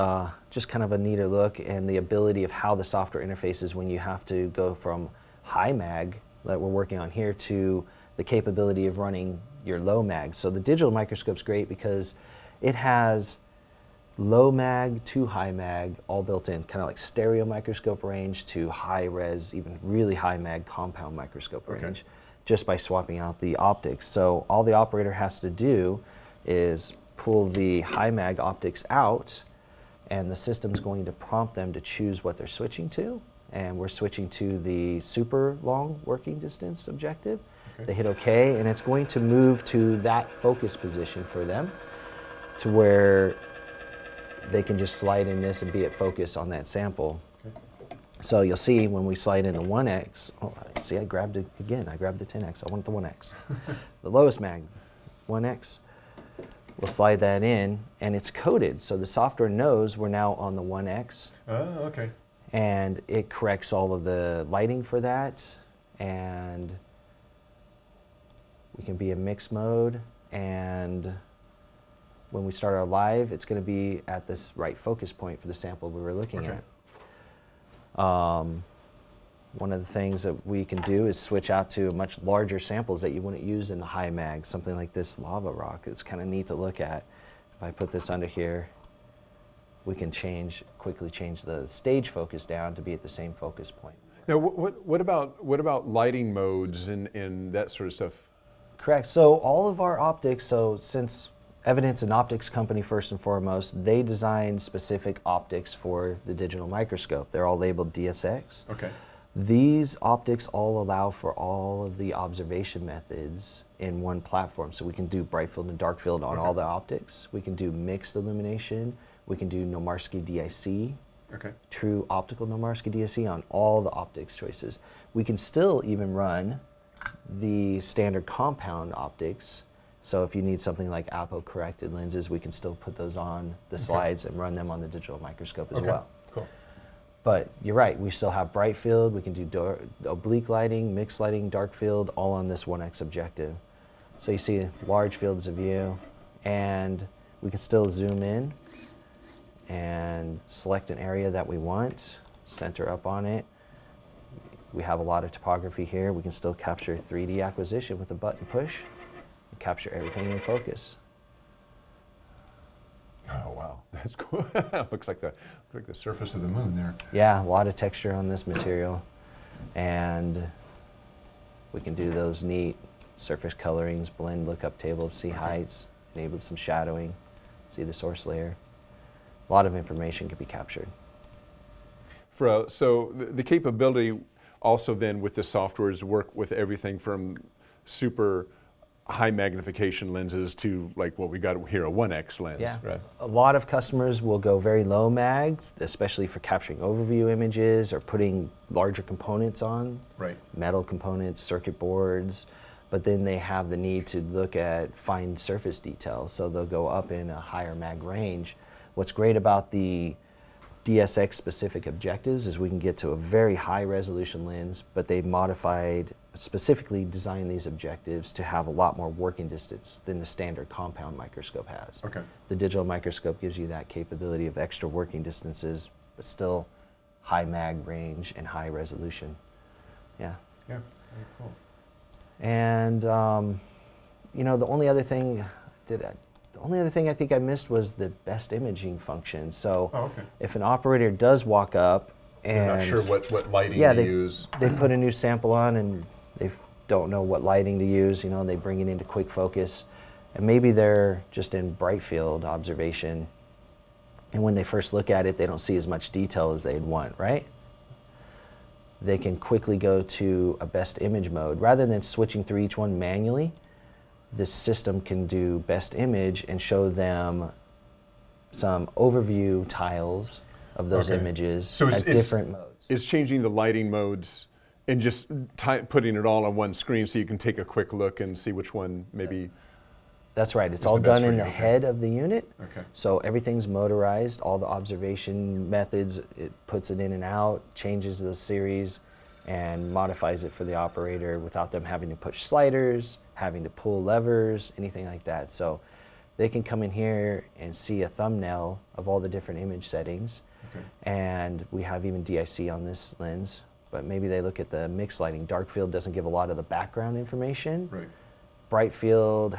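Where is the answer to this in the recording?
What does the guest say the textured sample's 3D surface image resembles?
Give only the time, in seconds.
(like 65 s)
165 s.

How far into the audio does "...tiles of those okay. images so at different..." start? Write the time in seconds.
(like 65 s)
269 s.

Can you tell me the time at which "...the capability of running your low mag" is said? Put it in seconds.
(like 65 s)
8 s.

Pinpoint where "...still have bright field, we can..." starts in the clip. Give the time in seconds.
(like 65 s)
138 s.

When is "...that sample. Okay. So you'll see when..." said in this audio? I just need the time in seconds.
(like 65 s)
46 s.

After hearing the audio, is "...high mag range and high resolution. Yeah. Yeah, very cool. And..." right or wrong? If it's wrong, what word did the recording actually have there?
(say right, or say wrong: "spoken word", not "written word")
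right.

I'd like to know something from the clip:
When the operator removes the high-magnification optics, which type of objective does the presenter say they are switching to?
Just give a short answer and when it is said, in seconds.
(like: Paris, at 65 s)
super long working distance objective, at 35 s.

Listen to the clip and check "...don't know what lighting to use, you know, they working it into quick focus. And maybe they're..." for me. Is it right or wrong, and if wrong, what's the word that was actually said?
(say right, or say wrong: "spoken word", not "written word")
wrong: "bring", not "working".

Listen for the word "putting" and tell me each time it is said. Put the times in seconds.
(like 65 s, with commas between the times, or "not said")
198 s, 275 s.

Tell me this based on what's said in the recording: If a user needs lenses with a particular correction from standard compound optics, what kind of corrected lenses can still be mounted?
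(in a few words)
apo corrected lenses.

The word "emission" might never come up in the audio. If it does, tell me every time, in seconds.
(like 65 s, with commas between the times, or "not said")
not said.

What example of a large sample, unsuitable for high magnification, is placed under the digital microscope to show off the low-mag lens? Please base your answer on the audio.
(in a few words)
lava rock.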